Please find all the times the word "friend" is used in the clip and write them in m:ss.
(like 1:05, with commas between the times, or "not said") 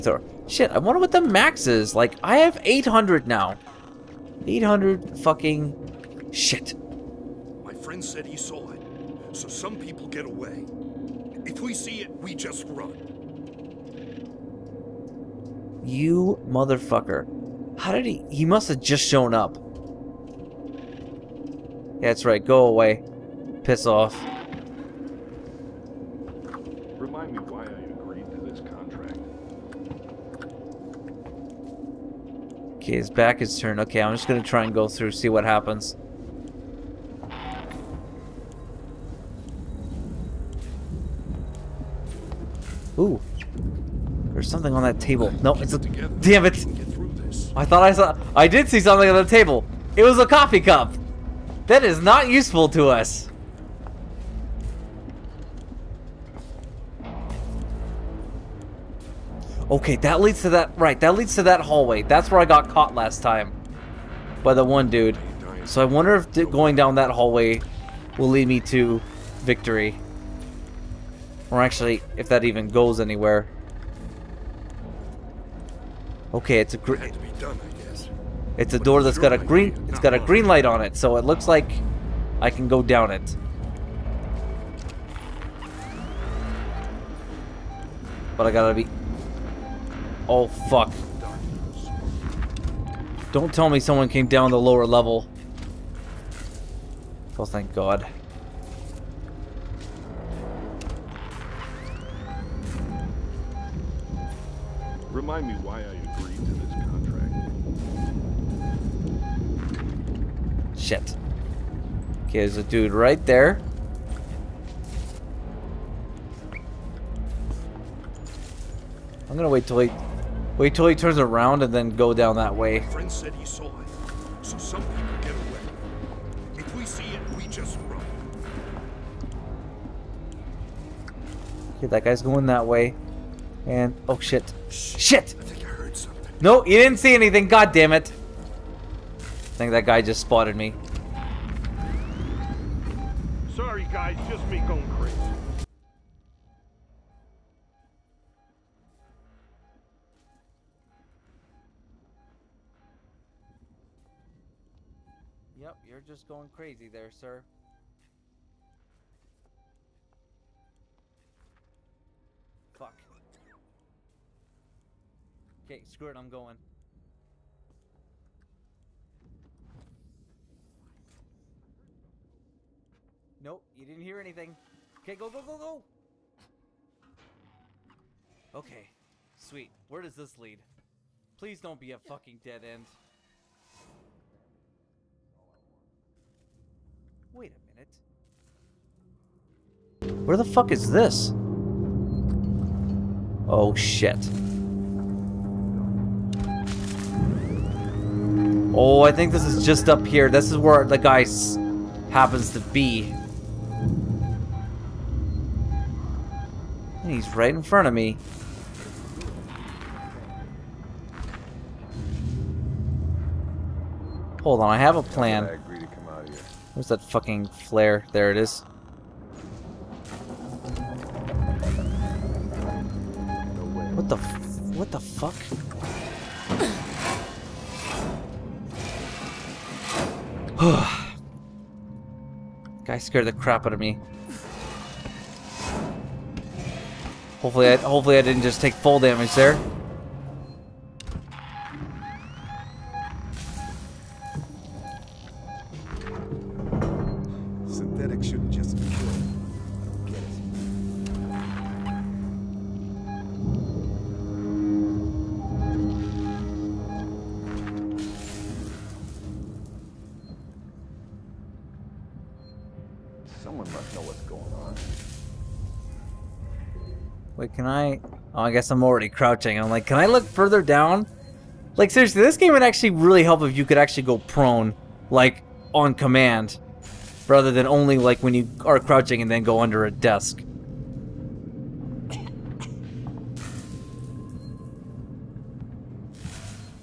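0:07, 2:02.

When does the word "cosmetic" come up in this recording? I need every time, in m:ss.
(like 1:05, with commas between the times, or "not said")
not said.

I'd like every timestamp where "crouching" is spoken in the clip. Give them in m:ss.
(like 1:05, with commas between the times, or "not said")
4:29, 4:38.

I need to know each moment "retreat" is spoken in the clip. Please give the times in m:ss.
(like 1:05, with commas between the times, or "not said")
not said.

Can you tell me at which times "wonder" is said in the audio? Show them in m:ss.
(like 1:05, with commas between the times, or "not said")
0:00, 1:05.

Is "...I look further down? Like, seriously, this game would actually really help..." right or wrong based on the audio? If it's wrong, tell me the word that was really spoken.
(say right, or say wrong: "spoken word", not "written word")
right.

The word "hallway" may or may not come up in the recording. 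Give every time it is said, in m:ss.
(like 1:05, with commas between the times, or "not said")
1:01, 1:07.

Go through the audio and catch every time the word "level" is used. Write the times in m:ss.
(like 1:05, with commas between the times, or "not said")
1:34.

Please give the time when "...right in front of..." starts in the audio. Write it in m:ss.
3:27.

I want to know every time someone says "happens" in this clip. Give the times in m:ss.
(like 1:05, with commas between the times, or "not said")
0:35, 3:22.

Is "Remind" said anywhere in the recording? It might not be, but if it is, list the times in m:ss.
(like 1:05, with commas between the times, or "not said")
0:26, 1:45.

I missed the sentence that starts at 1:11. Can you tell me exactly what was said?
Or actually, if that even goes anywhere.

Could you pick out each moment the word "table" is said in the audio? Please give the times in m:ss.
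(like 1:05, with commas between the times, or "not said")
0:44, 0:49.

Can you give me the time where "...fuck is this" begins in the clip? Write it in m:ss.
3:10.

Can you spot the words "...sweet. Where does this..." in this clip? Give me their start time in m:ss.
2:59.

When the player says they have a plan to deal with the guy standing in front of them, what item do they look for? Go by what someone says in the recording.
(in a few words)
flare.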